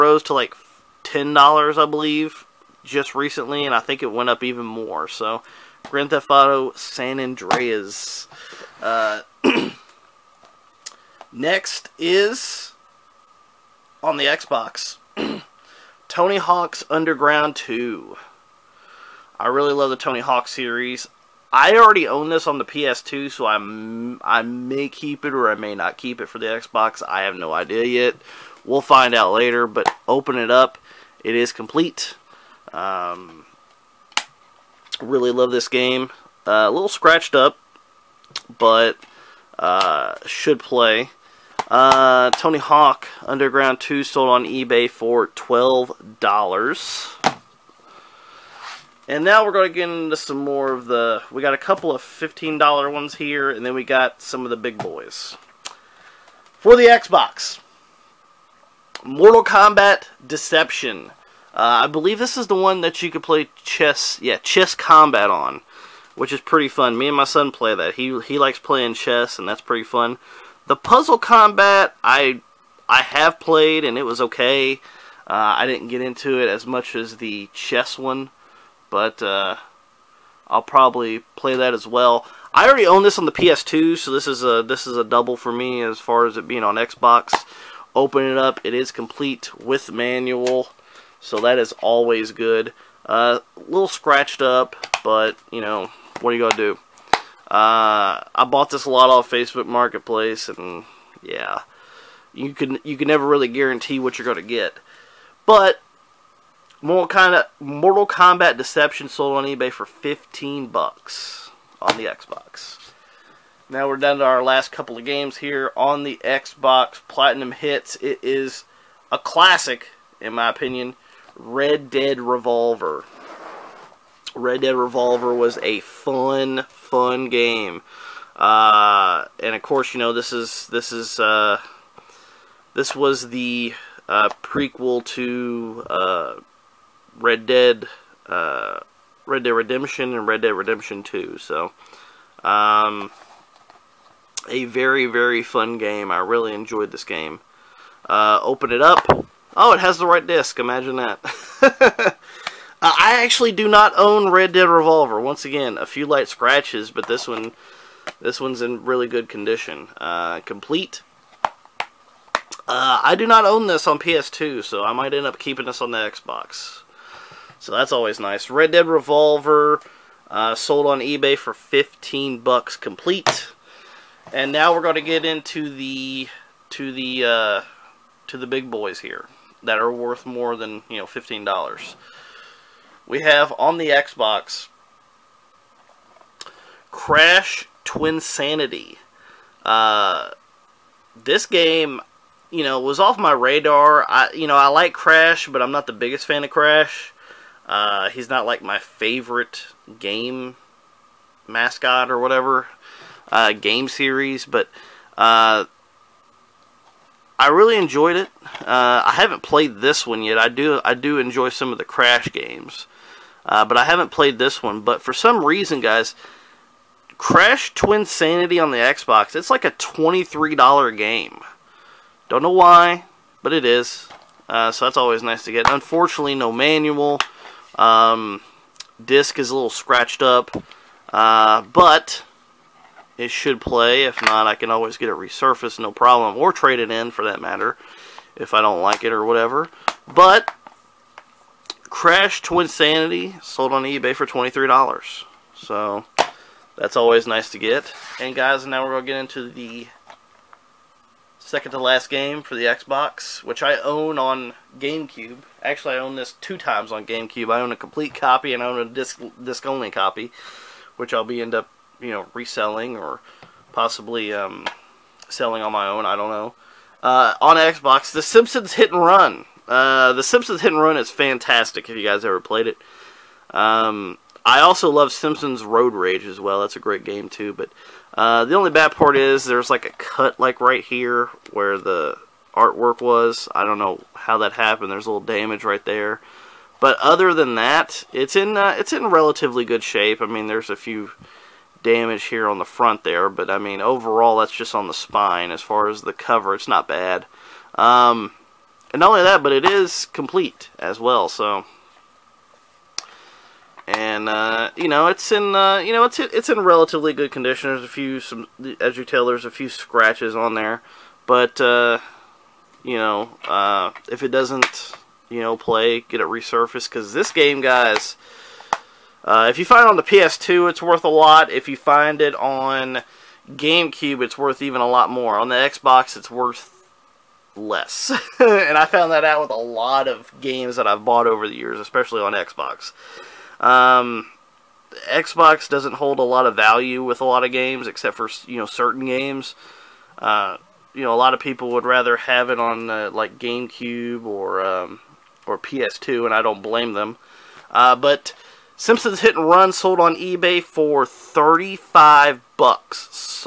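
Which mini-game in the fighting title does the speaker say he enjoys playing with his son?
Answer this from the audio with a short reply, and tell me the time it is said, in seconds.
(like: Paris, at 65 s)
Chess Kombat, at 64 s.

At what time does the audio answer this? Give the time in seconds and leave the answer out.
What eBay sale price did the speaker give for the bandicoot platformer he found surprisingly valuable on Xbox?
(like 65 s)
219 s.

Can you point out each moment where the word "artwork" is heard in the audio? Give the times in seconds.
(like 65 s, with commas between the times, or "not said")
282 s.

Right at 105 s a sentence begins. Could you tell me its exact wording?
But Mortal kind of Mortal Kombat Deception sold on eBay for 15 bucks on the Xbox.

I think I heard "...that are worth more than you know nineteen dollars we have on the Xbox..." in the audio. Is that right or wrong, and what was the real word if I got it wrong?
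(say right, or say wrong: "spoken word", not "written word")
wrong: "fifteen", not "nineteen".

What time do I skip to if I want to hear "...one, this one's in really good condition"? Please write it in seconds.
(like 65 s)
157 s.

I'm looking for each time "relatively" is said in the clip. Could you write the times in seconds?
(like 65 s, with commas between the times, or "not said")
289 s, 306 s.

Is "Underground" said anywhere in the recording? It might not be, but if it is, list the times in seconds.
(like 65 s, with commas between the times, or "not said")
16 s, 43 s.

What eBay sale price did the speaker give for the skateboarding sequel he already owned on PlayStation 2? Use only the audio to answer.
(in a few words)
$12.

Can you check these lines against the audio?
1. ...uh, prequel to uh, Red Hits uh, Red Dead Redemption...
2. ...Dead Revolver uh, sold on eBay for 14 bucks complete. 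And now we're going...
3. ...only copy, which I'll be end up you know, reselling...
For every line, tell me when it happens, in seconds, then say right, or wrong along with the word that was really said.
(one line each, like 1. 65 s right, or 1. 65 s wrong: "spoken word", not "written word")
1. 134 s wrong: "Dead", not "Hits"
2. 168 s wrong: "15", not "14"
3. 259 s right.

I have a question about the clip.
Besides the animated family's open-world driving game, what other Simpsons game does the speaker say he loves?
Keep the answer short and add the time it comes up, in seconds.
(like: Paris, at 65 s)
Simpsons Road Rage, at 275 s.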